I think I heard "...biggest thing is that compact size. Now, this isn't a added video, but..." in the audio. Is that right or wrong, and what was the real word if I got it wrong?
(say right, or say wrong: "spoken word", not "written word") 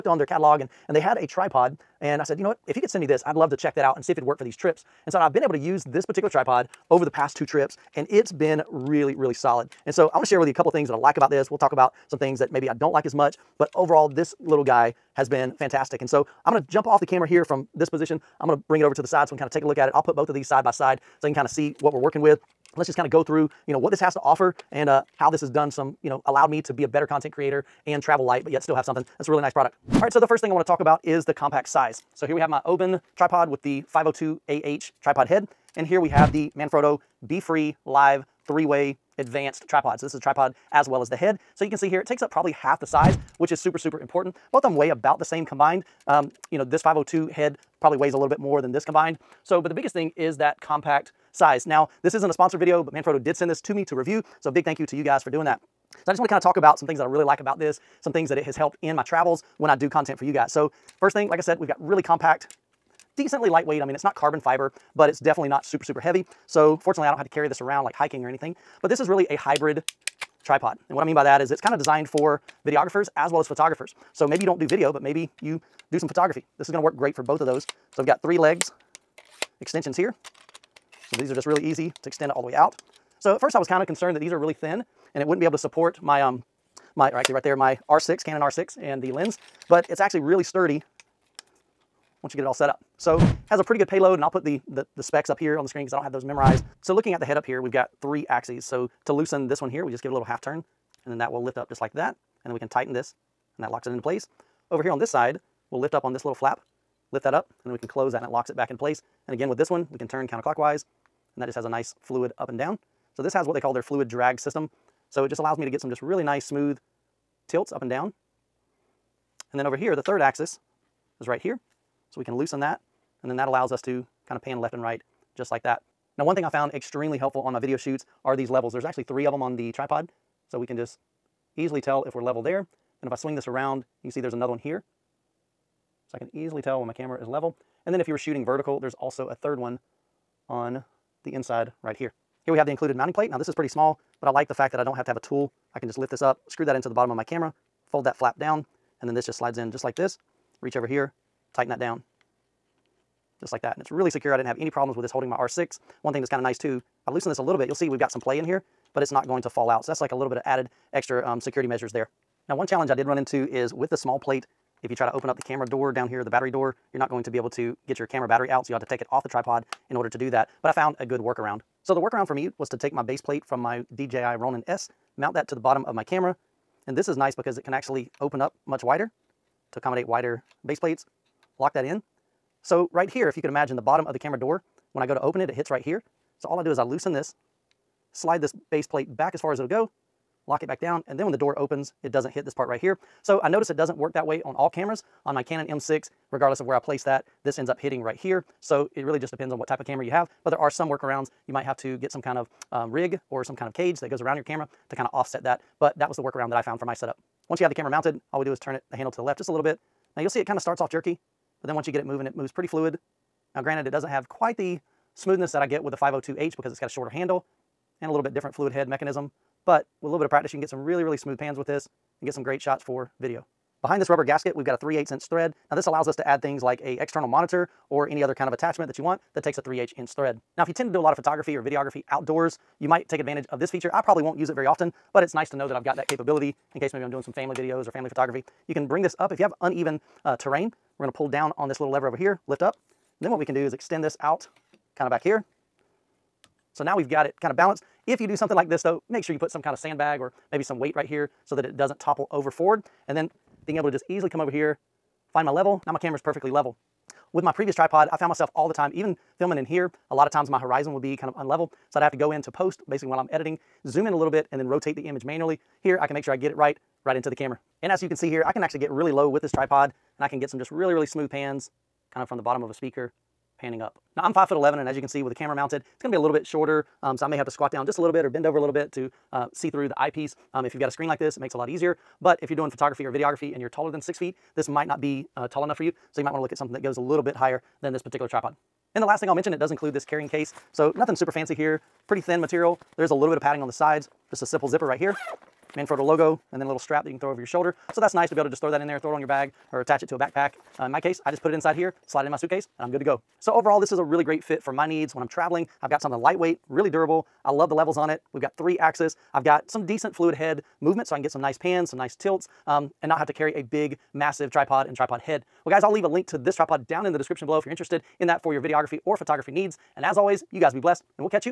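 wrong: "sponsored", not "added".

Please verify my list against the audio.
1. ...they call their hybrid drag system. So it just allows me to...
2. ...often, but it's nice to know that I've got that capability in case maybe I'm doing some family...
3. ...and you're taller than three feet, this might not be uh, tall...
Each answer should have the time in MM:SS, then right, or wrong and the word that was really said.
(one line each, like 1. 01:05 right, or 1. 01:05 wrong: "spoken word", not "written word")
1. 01:53 wrong: "fluid", not "hybrid"
2. 03:54 right
3. 04:43 wrong: "six", not "three".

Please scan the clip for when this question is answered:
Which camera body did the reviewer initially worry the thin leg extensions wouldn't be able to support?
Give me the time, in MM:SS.
01:28.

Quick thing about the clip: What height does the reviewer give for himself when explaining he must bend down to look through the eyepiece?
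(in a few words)
5 foot 11.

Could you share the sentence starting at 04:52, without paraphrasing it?
There's a little bit of padding on the sides, just a simple zipper right here.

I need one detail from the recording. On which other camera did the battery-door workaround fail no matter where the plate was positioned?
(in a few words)
Canon M6.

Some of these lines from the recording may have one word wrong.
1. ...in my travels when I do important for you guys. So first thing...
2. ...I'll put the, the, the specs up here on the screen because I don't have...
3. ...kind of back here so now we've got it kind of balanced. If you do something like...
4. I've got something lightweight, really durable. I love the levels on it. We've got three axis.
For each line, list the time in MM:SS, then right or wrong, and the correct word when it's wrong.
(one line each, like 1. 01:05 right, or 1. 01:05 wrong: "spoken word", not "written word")
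1. 00:58 wrong: "content", not "important"
2. 01:34 right
3. 04:04 right
4. 05:05 right.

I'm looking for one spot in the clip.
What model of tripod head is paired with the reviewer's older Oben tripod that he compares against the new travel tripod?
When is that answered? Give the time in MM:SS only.
00:33.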